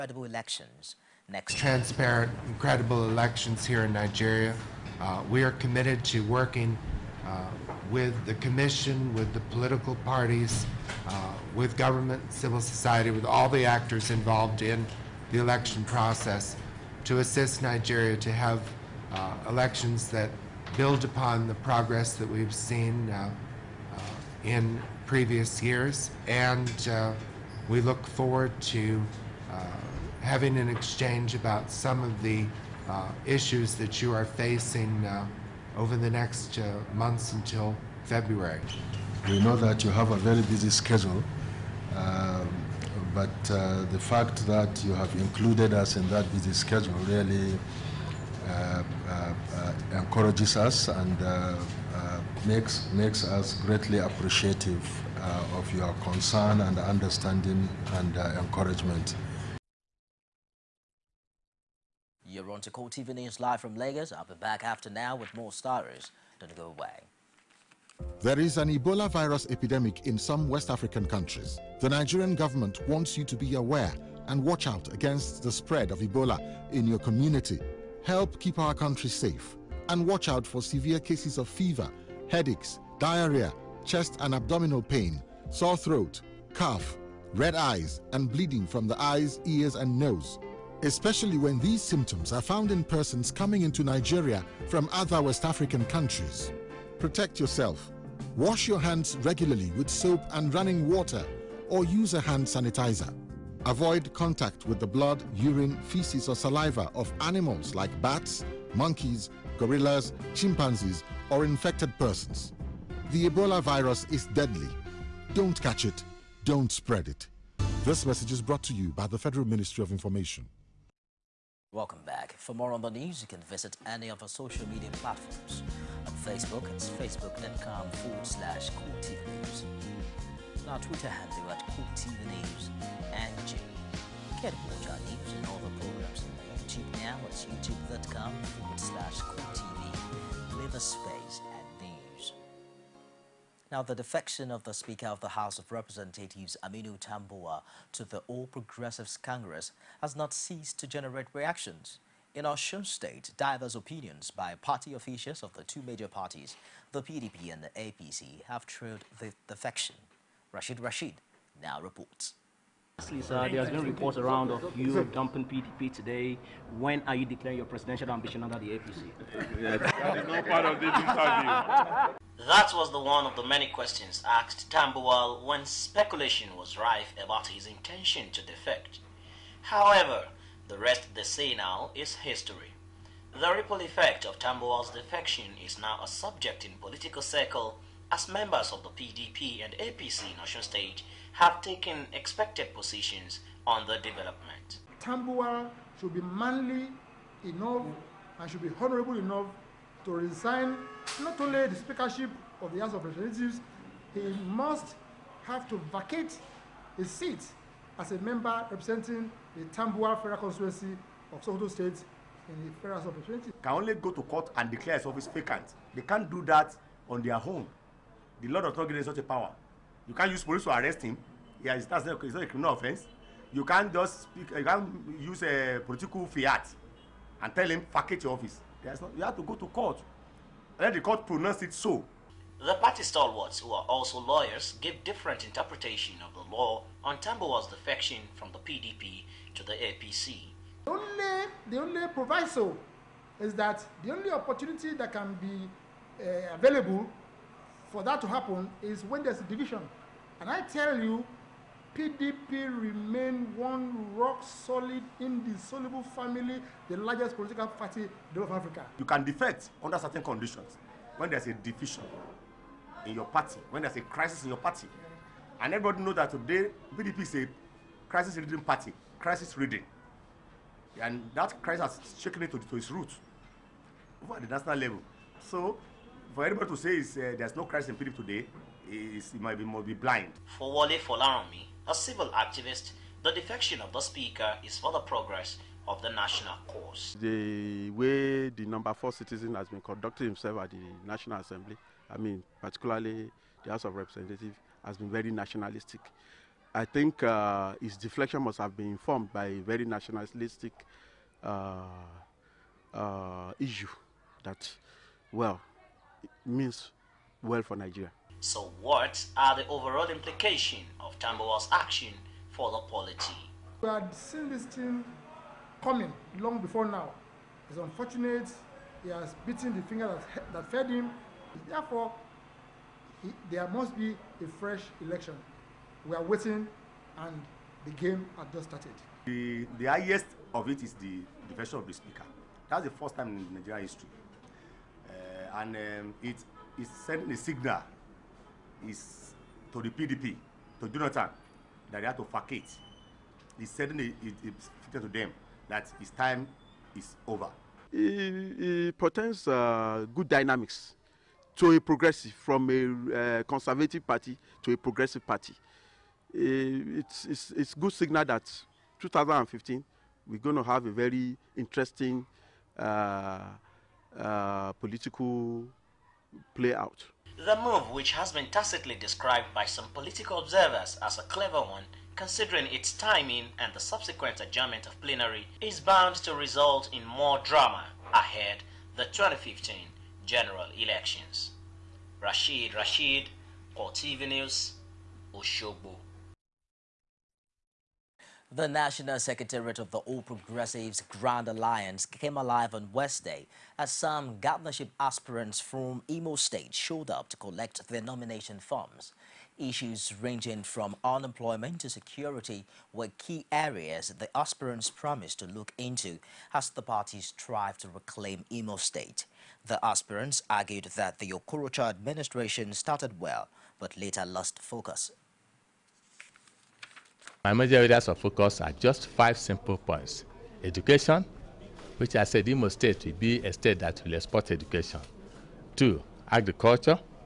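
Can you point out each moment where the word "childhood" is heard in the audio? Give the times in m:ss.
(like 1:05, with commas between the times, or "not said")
not said.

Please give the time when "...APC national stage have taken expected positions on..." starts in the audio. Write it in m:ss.
3:09.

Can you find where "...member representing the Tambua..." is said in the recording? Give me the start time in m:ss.
3:28.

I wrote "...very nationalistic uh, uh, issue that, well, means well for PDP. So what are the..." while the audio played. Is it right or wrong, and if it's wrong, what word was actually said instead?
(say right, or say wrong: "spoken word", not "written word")
wrong: "Nigeria", not "PDP".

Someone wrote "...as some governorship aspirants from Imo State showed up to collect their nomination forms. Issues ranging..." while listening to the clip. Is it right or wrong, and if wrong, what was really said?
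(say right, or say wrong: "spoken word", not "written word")
right.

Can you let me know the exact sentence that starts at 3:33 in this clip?
Can only go to court and declare his office vacant.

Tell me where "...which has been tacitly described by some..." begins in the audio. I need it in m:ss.
6:07.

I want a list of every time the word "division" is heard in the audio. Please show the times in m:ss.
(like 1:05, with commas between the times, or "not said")
4:09, 4:21.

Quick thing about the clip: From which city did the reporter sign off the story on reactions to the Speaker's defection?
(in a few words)
Oshogbo.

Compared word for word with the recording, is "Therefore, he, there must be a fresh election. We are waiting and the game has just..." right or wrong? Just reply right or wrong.
right.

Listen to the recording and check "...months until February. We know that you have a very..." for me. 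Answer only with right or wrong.
right.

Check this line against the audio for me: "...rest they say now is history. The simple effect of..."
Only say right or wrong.
wrong.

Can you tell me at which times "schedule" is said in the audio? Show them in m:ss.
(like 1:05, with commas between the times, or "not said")
0:40, 0:46.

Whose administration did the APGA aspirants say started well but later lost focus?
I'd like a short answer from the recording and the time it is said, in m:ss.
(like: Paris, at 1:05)
Okorocha, at 6:51.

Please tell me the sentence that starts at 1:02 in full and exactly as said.
You're on Core TV News live from Lagos.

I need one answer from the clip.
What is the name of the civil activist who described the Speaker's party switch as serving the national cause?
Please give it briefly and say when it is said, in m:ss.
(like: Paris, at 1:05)
Wale Folaranmi, at 4:40.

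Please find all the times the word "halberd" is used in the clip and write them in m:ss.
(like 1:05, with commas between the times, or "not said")
not said.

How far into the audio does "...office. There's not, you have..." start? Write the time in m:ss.
3:48.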